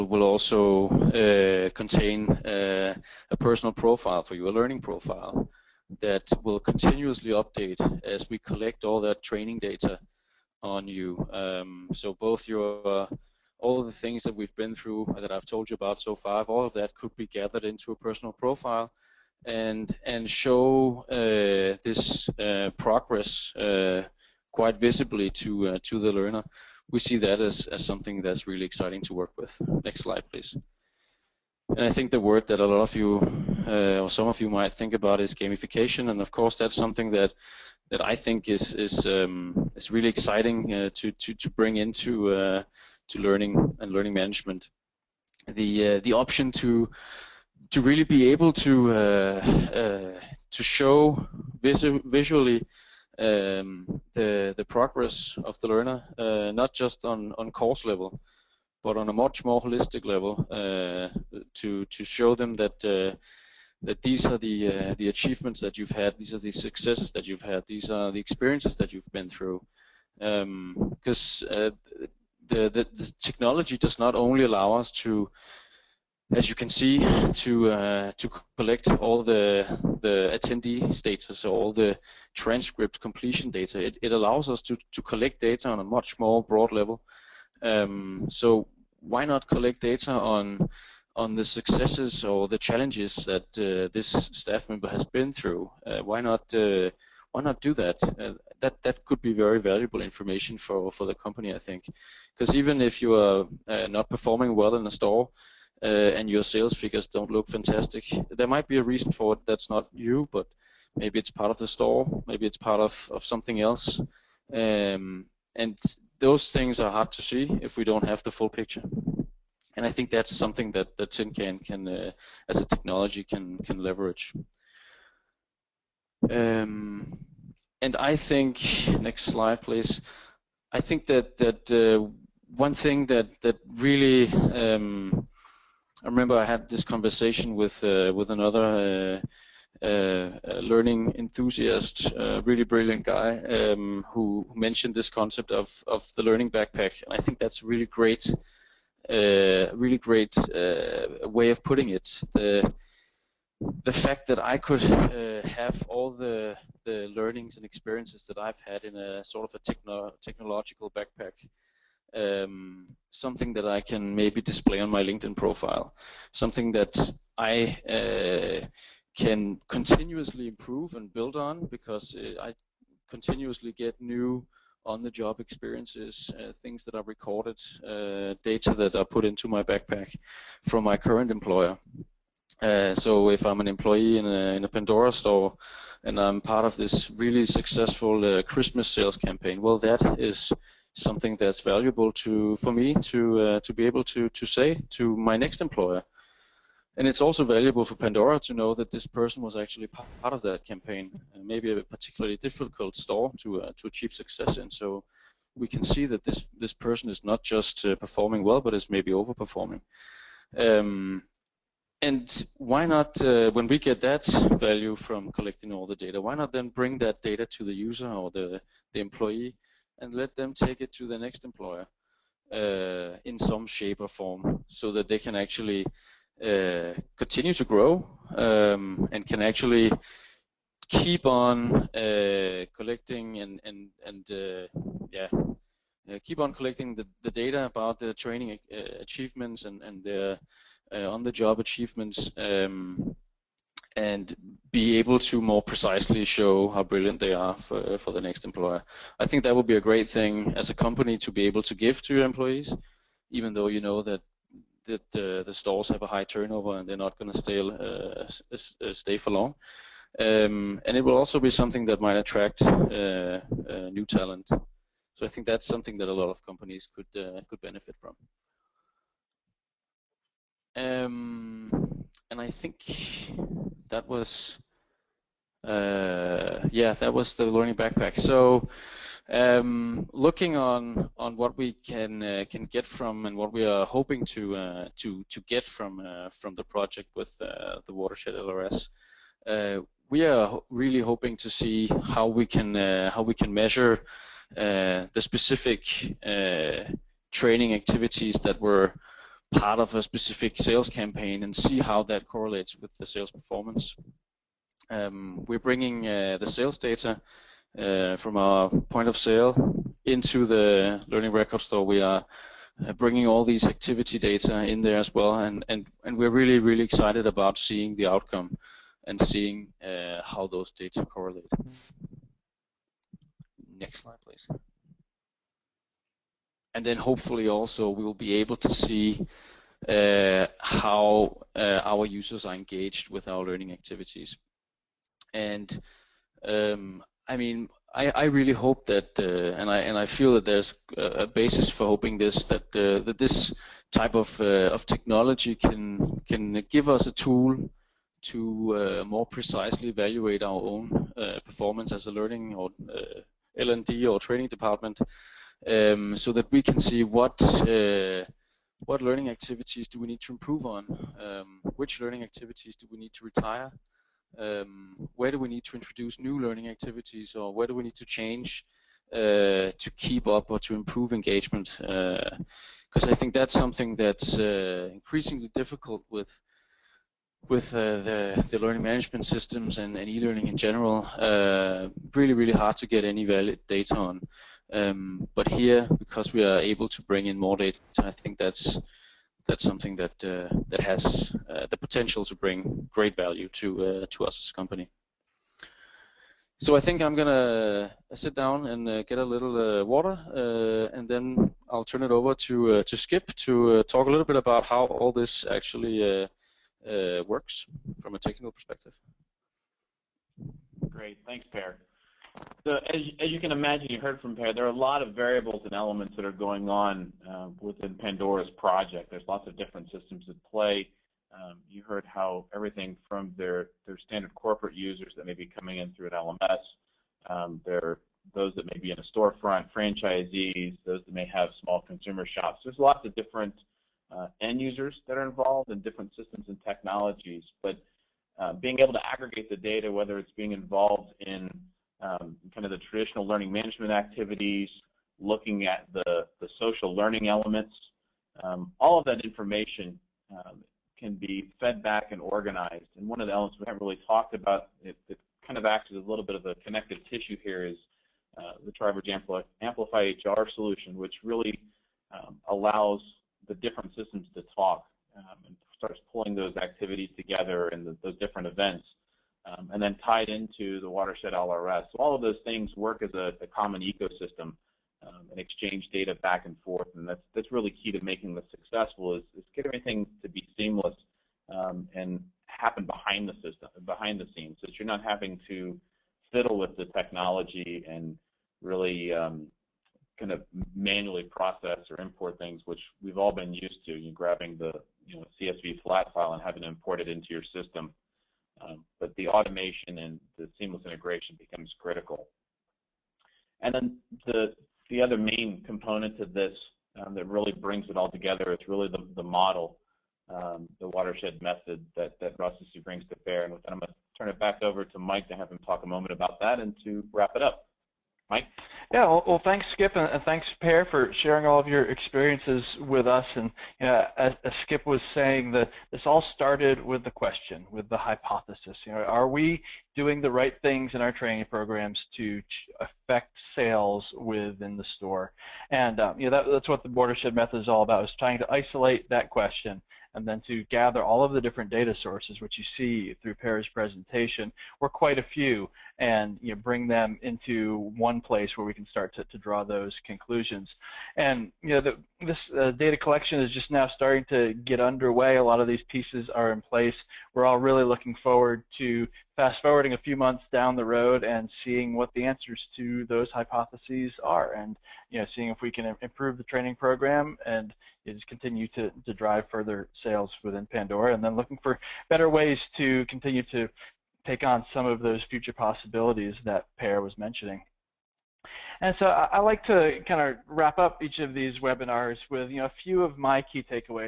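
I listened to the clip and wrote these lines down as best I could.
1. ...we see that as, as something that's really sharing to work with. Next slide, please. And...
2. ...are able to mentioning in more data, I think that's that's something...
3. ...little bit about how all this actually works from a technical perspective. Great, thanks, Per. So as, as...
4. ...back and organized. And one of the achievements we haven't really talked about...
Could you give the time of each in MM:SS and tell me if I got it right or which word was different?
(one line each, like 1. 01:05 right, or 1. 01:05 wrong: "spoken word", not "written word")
1. 00:26 wrong: "exciting", not "sharing"
2. 06:26 wrong: "bring", not "mentioning"
3. 06:44 right
4. 07:31 wrong: "elements", not "achievements".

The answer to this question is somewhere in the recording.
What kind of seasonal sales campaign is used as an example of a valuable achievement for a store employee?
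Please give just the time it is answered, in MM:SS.
03:08.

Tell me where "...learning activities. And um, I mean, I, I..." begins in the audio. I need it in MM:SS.
05:33.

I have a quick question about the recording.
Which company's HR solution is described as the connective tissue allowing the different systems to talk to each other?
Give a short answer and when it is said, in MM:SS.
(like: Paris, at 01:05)
Tribridge, at 07:38.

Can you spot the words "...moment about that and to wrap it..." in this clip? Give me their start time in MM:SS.
08:35.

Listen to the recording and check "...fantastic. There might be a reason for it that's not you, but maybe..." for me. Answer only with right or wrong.
right.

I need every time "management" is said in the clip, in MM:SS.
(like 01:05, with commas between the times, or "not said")
00:44, 06:18, 07:23.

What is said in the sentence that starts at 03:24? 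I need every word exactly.
So we can see that this this person is not just uh, performing well, but is maybe overperforming.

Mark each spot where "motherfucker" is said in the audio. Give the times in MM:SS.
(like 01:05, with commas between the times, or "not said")
not said.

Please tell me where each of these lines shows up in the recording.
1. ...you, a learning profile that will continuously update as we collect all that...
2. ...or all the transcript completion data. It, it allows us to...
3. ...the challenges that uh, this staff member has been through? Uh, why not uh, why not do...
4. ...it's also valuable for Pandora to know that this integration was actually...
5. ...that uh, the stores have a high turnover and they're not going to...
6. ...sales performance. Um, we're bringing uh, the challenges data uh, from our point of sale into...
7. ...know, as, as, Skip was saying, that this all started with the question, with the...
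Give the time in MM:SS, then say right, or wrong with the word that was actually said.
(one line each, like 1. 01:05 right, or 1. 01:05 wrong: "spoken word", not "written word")
1. 00:04 right
2. 01:21 right
3. 01:32 right
4. 03:17 wrong: "person", not "integration"
5. 04:14 right
6. 05:03 wrong: "sales", not "challenges"
7. 08:43 right.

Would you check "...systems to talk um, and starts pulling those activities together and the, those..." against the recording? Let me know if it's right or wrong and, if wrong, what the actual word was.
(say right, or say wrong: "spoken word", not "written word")
right.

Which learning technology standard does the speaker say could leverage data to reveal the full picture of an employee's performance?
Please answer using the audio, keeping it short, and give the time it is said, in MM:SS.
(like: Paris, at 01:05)
TinCan, at 02:01.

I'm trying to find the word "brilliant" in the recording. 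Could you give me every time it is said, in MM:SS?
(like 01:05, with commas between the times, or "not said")
02:22, 04:06.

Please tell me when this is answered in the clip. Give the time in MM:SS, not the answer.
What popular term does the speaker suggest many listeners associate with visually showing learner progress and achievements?
00:35.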